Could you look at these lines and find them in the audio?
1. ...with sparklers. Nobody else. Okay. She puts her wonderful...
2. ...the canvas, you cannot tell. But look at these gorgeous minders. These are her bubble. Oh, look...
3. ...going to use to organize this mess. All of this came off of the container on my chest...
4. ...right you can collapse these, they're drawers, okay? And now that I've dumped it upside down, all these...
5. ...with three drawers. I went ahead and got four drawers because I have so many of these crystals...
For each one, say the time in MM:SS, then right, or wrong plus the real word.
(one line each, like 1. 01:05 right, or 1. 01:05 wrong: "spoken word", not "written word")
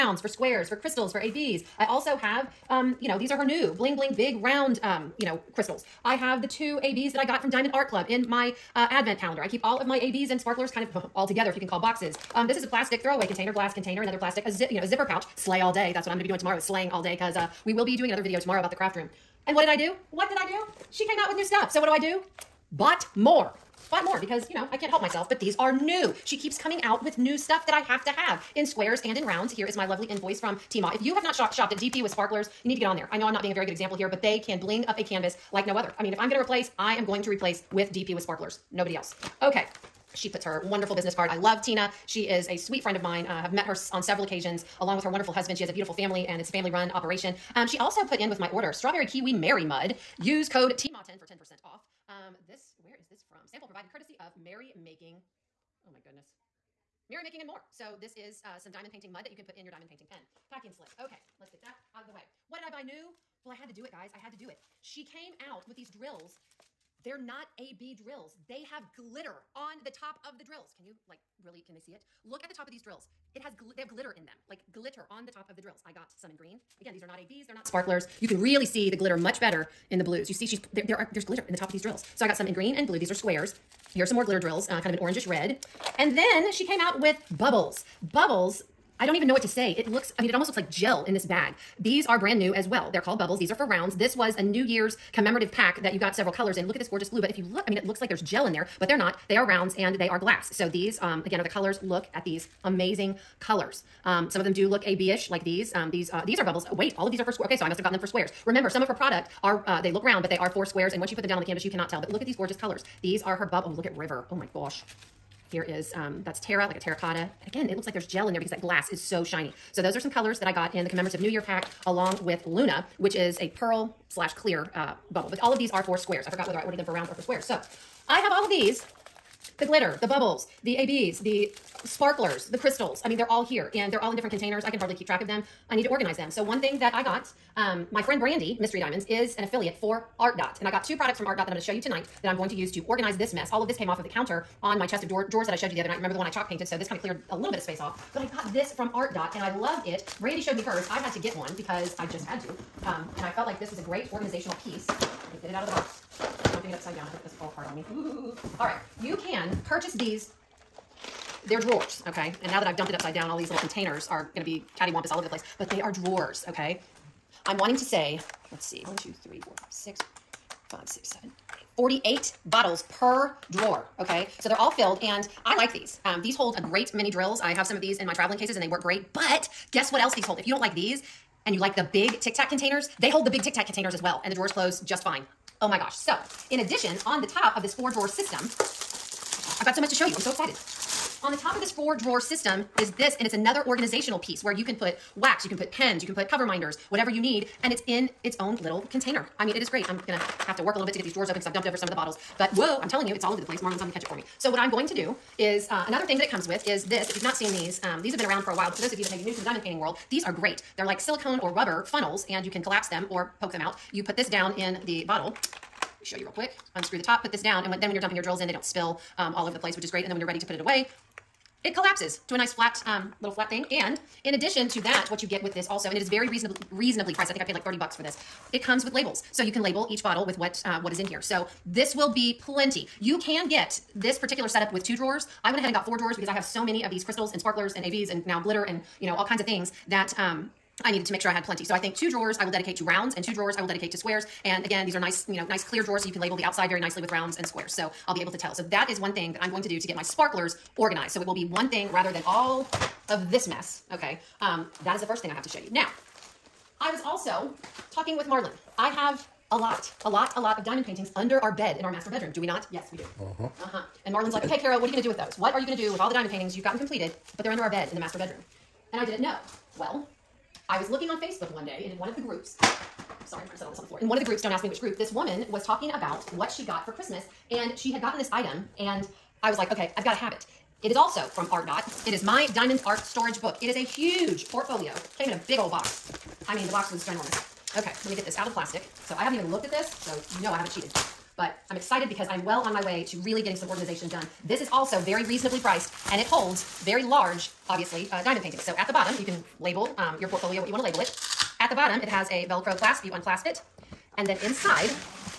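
1. 00:38 right
2. 01:51 wrong: "colors", not "minders"
3. 02:22 wrong: "counter", not "container"
4. 02:38 wrong: "purchase", not "collapse"
5. 03:54 wrong: "two", not "three".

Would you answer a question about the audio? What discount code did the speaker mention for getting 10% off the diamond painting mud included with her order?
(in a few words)
TMA10.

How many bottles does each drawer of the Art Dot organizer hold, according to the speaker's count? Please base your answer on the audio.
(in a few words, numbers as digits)
48.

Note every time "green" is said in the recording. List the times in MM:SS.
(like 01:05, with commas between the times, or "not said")
01:16, 01:22.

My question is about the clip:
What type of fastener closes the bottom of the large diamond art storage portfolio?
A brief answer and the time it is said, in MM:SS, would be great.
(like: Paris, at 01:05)
Velcro clasp, at 05:02.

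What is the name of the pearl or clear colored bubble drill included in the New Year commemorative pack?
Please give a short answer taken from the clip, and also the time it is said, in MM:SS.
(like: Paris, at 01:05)
Luna, at 02:02.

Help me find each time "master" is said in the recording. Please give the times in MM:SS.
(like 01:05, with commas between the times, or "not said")
04:21, 04:27.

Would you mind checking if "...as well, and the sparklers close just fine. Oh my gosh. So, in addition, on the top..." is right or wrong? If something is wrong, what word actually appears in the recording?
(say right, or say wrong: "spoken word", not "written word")
wrong: "drawers", not "sparklers".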